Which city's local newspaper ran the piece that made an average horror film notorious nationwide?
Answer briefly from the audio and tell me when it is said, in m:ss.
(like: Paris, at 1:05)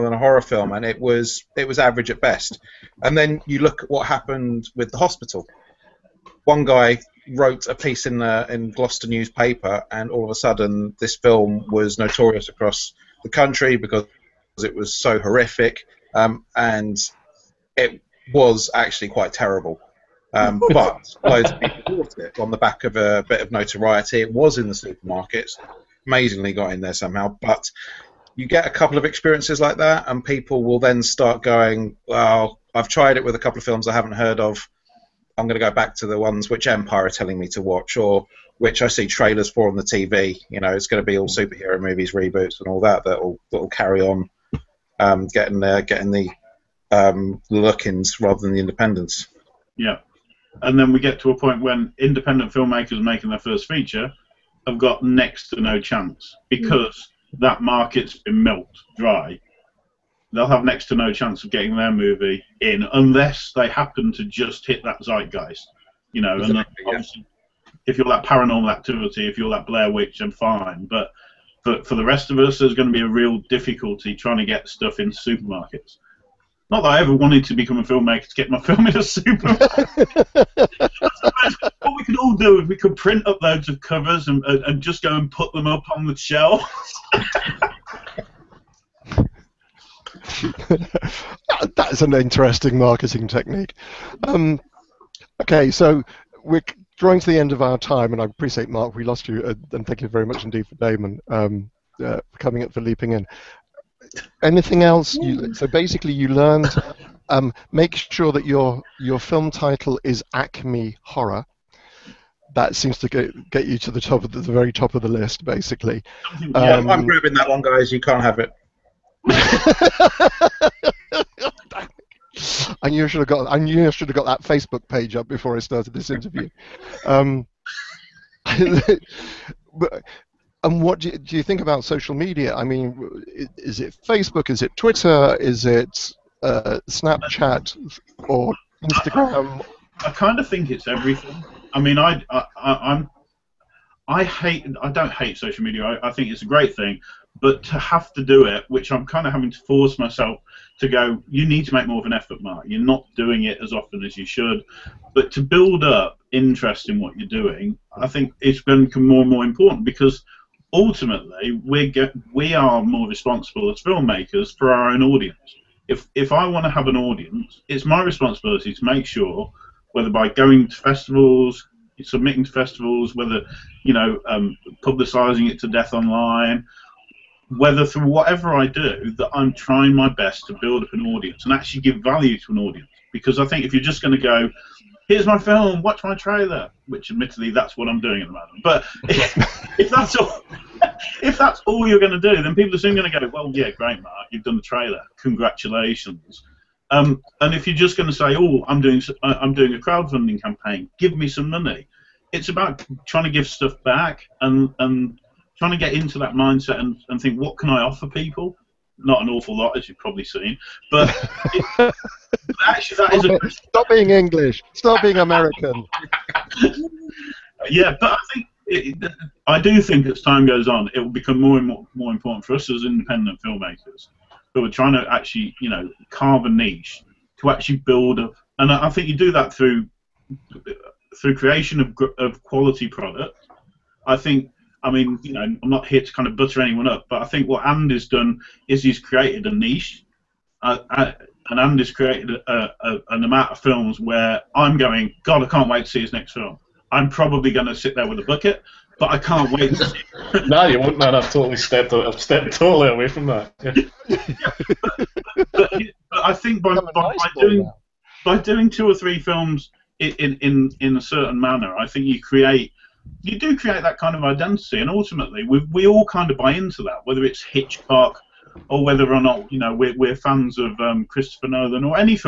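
Gloucester, at 0:08.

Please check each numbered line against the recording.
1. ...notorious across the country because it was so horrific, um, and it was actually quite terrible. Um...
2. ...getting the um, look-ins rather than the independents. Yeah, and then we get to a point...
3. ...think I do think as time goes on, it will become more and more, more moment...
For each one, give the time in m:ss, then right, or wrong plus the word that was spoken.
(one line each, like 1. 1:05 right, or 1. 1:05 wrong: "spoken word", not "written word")
1. 0:11 right
2. 0:45 right
3. 3:38 wrong: "important", not "moment".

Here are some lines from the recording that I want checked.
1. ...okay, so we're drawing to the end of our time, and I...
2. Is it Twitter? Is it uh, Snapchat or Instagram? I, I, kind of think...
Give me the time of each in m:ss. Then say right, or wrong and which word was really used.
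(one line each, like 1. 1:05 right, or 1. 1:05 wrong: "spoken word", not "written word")
1. 1:35 right
2. 2:14 right.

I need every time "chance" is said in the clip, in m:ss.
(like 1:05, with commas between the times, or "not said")
0:55, 1:01.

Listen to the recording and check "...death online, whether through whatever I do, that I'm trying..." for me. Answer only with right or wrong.
right.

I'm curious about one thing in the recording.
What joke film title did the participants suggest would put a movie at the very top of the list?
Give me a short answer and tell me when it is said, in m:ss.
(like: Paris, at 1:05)
Acme Horror, at 1:50.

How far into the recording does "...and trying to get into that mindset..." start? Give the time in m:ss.
3:24.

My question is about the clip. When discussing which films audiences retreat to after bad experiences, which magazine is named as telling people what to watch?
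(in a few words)
Empire.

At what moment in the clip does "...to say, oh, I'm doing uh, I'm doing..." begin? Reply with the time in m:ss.
3:18.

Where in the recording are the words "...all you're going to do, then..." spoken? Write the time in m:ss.
3:11.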